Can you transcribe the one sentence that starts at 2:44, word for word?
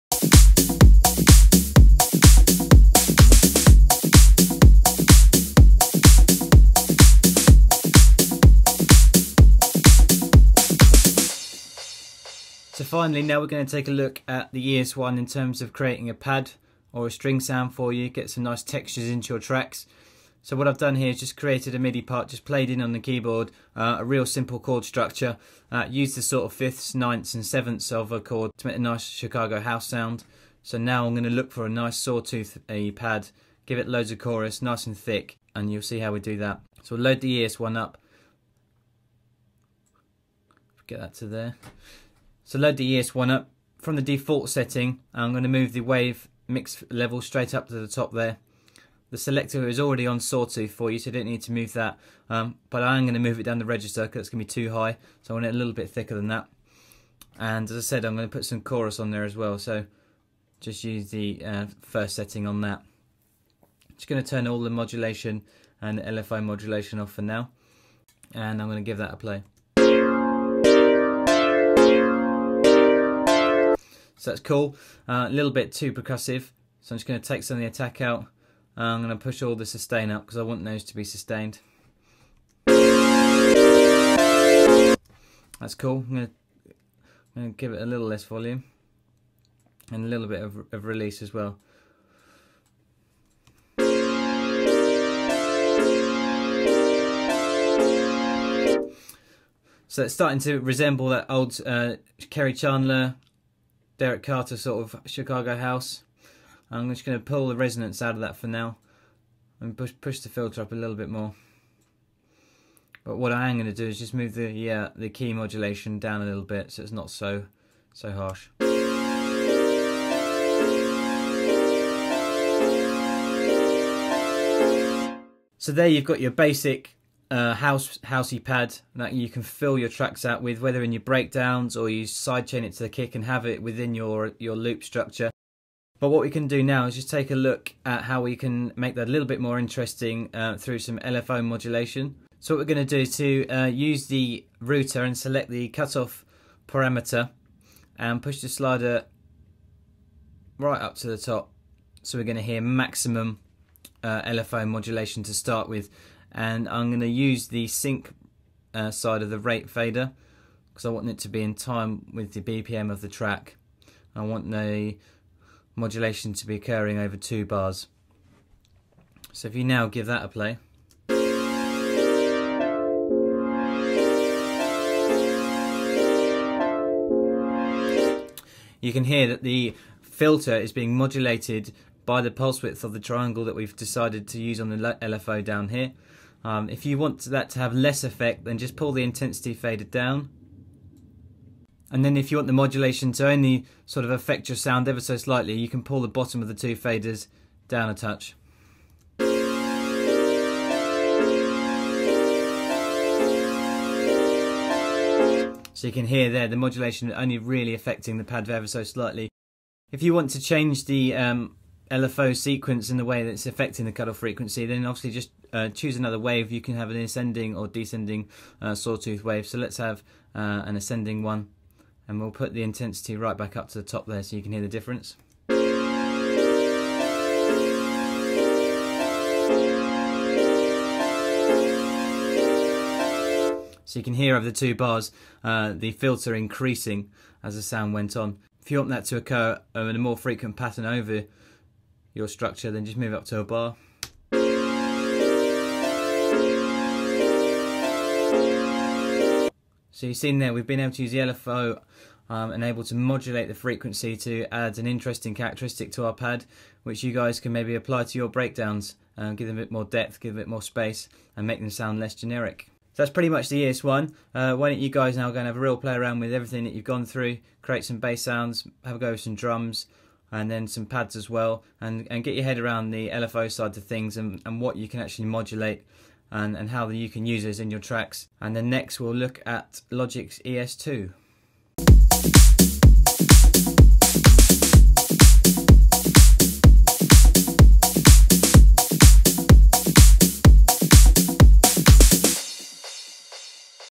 I want the modulation to be occurring over two bars.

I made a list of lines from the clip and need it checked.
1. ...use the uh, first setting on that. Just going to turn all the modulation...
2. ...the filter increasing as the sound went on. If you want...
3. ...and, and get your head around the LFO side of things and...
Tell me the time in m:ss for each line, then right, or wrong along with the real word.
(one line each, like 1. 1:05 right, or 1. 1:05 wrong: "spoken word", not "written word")
1. 1:00 right
2. 3:55 right
3. 4:31 right.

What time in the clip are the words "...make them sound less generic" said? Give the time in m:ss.
4:21.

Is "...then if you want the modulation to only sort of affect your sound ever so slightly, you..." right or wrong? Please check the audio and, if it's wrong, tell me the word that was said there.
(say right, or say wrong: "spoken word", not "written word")
right.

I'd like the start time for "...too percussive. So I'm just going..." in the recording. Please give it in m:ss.
1:15.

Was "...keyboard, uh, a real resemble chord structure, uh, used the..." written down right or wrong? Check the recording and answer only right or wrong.
wrong.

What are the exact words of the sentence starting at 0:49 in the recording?
The selector is already on sawtooth for you, so you don't need to move that.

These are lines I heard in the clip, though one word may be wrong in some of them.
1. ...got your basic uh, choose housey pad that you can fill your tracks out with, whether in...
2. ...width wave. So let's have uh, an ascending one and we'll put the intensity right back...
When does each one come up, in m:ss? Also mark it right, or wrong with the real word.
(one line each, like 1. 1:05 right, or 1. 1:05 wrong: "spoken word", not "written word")
1. 2:06 wrong: "house", not "choose"
2. 3:38 wrong: "sawtooth", not "width".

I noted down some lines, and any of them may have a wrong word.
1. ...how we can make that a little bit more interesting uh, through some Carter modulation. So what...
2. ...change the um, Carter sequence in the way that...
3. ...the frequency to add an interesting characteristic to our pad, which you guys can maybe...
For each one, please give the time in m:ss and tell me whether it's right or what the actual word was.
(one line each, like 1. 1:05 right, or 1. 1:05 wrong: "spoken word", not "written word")
1. 2:18 wrong: "LFO", not "Carter"
2. 3:30 wrong: "LFO", not "Carter"
3. 4:13 right.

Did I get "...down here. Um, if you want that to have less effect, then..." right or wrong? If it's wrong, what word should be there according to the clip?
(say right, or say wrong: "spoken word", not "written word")
right.